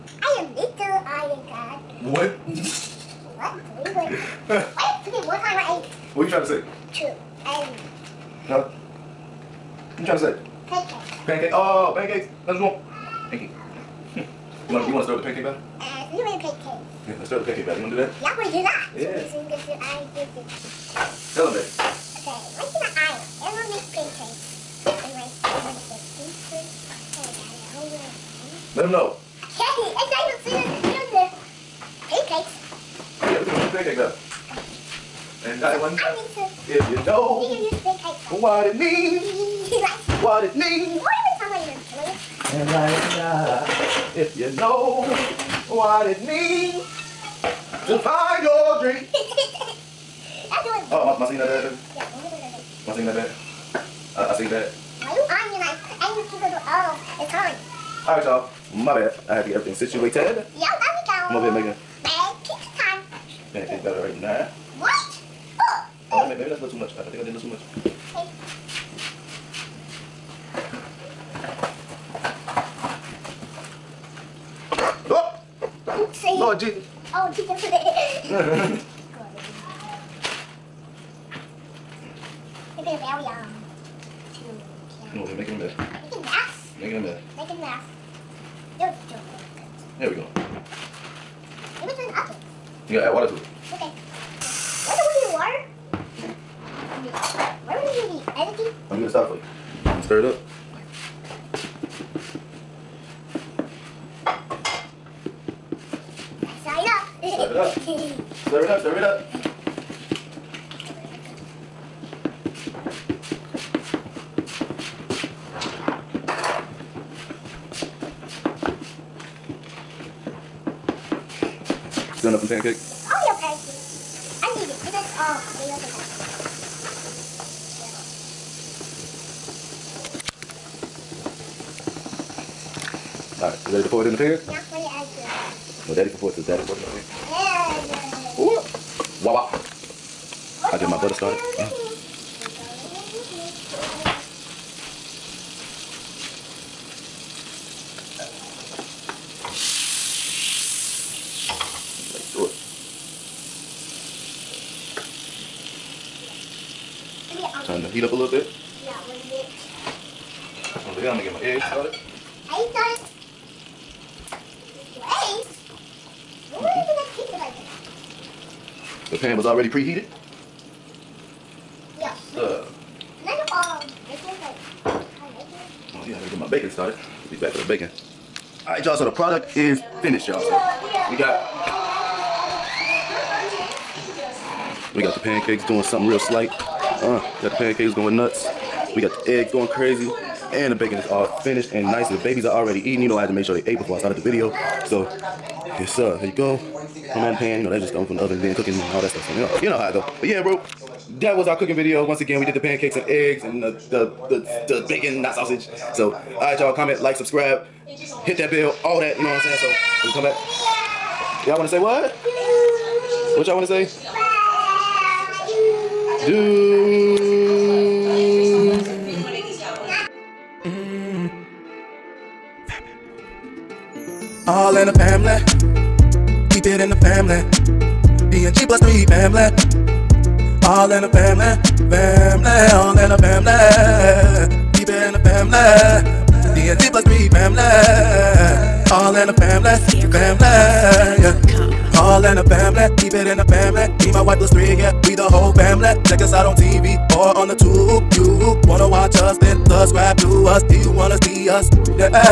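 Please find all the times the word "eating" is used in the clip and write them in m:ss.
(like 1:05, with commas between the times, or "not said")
3:12.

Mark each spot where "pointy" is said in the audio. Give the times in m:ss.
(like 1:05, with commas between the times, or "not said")
not said.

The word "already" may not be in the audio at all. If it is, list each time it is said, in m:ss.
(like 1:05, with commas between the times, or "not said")
2:49, 3:12.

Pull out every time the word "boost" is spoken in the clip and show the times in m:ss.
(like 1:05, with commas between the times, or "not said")
not said.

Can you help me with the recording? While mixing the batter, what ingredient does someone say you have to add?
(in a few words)
water.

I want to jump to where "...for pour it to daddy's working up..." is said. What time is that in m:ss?
2:16.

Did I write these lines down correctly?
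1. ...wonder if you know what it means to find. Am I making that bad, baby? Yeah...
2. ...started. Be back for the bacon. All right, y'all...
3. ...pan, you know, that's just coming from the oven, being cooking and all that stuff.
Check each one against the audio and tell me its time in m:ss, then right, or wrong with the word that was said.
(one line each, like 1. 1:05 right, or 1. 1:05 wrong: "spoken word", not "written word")
1. 0:43 wrong: "singing", not "making"
2. 2:56 right
3. 3:17 right.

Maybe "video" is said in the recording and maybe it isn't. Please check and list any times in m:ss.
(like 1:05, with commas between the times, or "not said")
3:14, 3:21.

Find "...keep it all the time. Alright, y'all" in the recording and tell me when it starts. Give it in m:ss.
0:56.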